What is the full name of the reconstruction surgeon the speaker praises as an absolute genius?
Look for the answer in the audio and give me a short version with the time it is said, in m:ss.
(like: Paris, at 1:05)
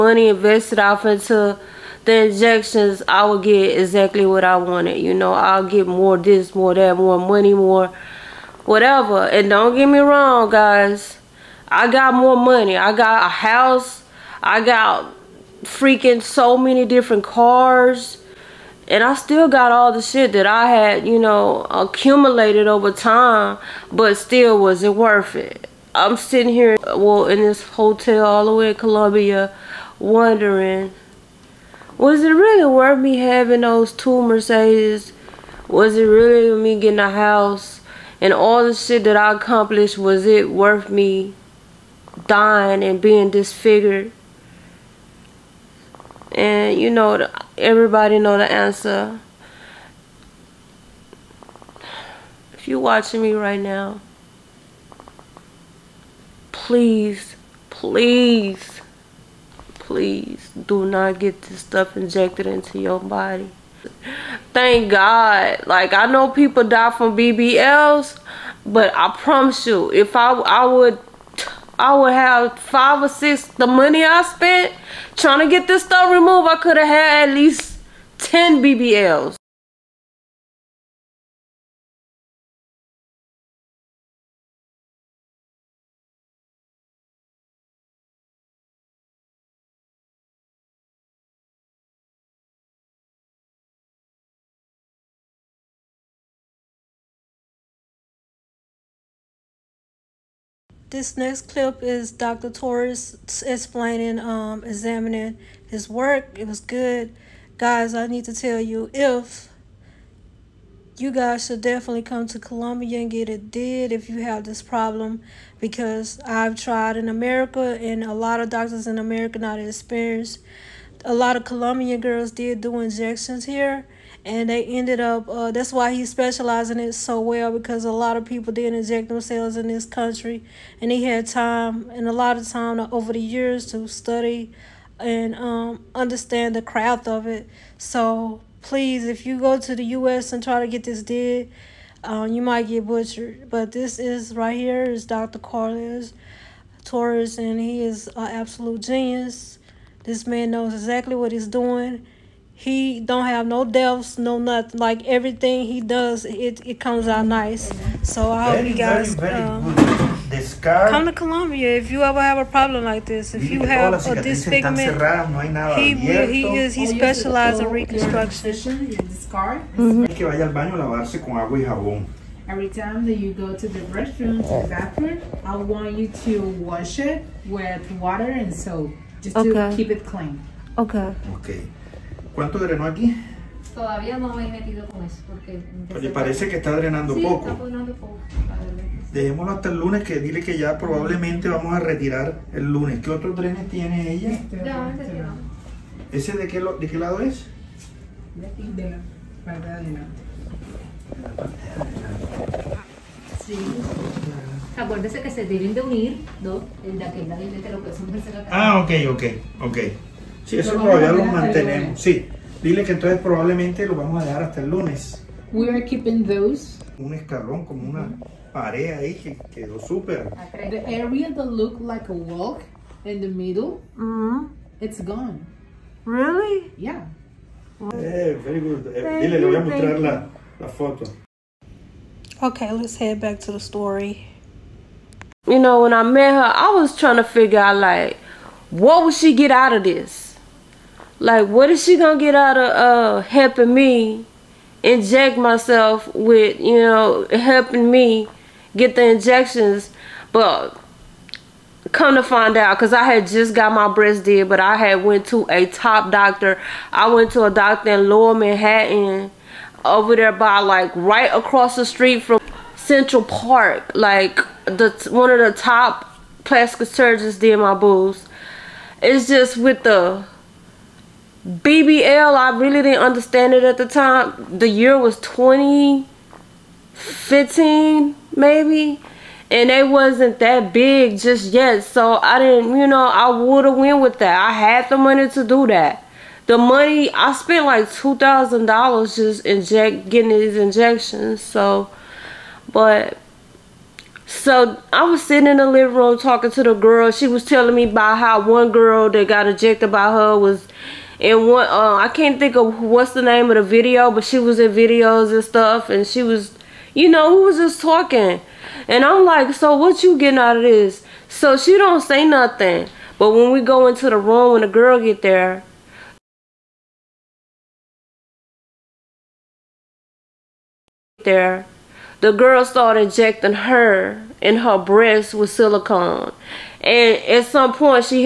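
Carlos Torres, at 2:25.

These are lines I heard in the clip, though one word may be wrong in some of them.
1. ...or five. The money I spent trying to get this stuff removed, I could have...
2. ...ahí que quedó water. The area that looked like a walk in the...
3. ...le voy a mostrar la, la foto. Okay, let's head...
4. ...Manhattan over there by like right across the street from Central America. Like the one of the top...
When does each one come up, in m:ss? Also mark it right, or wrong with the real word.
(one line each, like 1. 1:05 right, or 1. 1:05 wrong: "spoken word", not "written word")
1. 1:13 wrong: "six", not "five"
2. 3:38 wrong: "súper", not "water"
3. 3:49 right
4. 4:18 wrong: "Park", not "America".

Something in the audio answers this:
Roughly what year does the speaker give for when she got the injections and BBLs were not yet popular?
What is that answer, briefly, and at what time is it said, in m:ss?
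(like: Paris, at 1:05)
2015, at 4:35.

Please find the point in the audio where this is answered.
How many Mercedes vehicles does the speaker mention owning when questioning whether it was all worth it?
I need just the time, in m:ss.
0:33.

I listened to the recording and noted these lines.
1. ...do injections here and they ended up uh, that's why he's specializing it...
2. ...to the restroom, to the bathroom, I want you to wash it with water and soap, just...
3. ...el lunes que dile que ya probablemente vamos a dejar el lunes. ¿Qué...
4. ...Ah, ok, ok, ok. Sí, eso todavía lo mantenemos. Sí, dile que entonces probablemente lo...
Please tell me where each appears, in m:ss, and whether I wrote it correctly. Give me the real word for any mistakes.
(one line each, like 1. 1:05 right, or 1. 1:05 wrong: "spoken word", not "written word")
1. 2:02 right
2. 2:53 right
3. 3:09 wrong: "retirar", not "dejar"
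4. 3:28 right.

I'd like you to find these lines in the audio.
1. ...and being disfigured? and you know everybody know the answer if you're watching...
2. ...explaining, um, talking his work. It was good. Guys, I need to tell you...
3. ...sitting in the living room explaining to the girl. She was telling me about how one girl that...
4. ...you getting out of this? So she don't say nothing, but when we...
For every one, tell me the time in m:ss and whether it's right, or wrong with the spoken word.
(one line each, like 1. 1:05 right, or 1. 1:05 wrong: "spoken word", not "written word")
1. 0:42 right
2. 1:43 wrong: "examining", not "talking"
3. 4:55 wrong: "talking", not "explaining"
4. 5:10 right.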